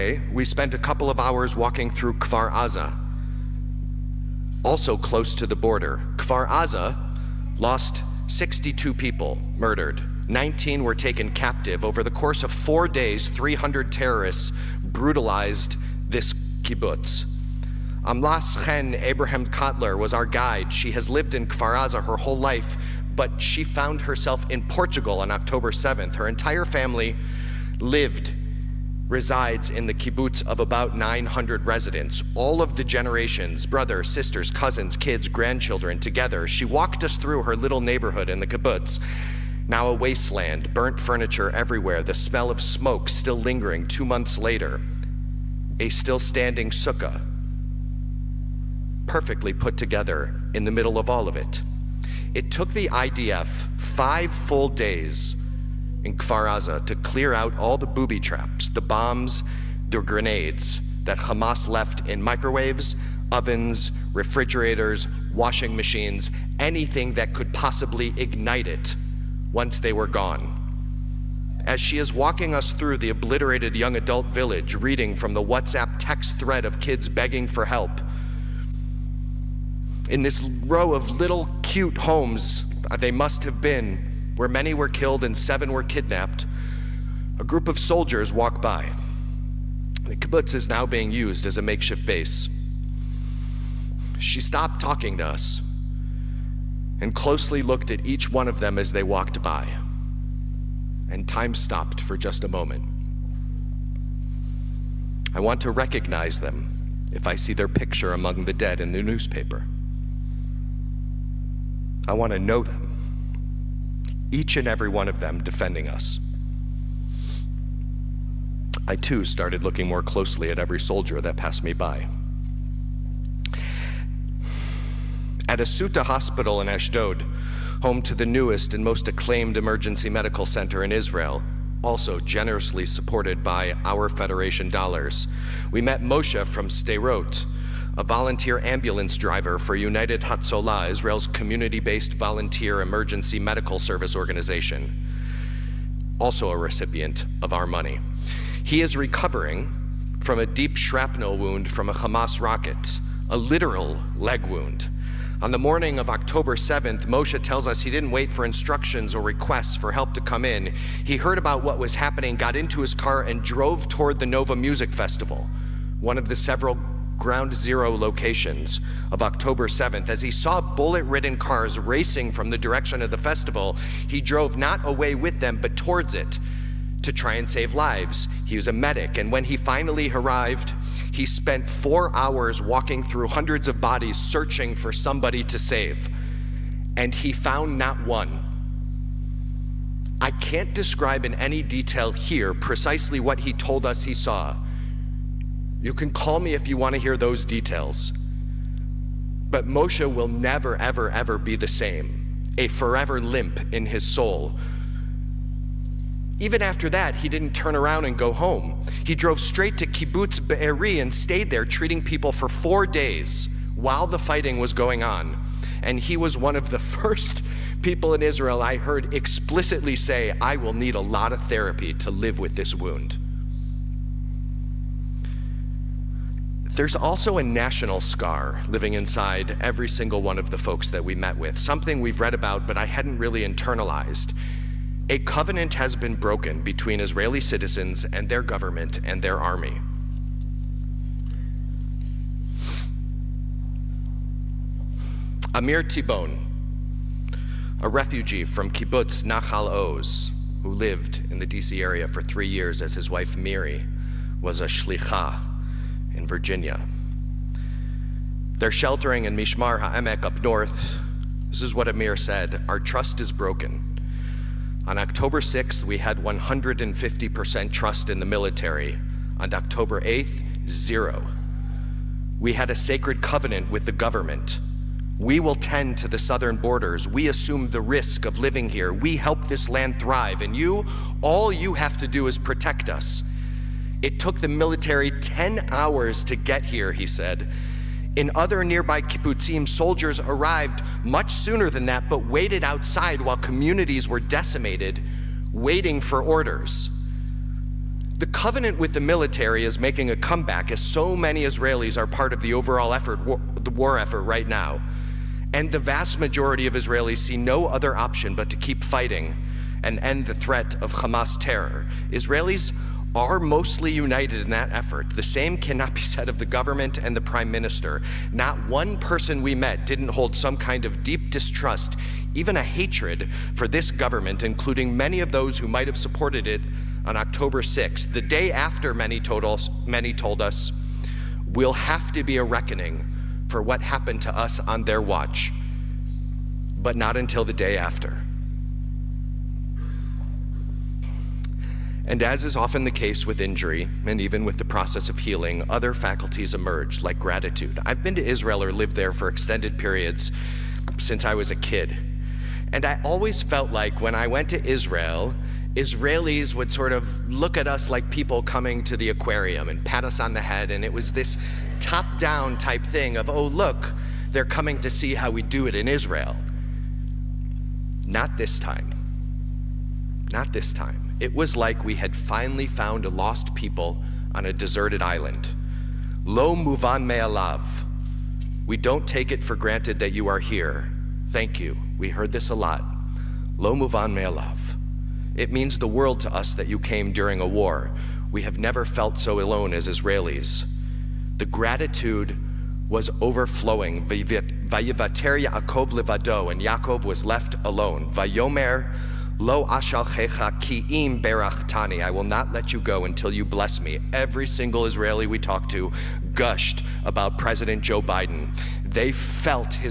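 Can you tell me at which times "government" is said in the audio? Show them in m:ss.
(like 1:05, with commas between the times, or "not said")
3:58, 4:33, 5:16, 5:23.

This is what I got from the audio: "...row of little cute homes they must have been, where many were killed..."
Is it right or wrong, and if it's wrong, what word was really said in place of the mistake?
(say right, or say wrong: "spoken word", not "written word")
right.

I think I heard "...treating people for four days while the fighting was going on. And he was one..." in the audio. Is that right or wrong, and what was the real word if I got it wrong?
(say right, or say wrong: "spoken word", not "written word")
right.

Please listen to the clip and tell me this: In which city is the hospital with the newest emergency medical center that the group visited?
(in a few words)
Ashdod.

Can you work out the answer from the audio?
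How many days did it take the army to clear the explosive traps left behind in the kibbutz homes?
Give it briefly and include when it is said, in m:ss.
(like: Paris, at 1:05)
5, at 0:53.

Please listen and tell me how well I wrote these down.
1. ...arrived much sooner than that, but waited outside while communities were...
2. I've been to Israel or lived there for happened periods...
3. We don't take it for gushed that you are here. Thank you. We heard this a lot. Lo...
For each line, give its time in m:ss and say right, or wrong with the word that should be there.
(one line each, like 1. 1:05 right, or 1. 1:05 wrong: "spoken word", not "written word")
1. 4:50 right
2. 5:47 wrong: "extended", not "happened"
3. 6:18 wrong: "granted", not "gushed".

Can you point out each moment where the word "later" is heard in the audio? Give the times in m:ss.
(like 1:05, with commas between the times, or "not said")
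0:44.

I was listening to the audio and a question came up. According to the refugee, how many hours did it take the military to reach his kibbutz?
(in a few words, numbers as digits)
10.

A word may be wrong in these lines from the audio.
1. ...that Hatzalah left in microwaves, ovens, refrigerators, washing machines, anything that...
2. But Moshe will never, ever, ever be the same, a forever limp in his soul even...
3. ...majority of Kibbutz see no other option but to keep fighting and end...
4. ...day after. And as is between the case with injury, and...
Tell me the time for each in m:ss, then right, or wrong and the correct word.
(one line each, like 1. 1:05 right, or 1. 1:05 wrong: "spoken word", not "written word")
1. 1:01 wrong: "Hamas", not "Hatzalah"
2. 3:19 right
3. 5:06 wrong: "Israelis", not "Kibbutz"
4. 5:37 wrong: "often", not "between".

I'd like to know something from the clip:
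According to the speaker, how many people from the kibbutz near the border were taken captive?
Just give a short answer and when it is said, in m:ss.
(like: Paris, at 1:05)
19, at 0:10.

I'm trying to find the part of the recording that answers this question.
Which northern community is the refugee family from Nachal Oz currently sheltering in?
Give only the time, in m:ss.
4:19.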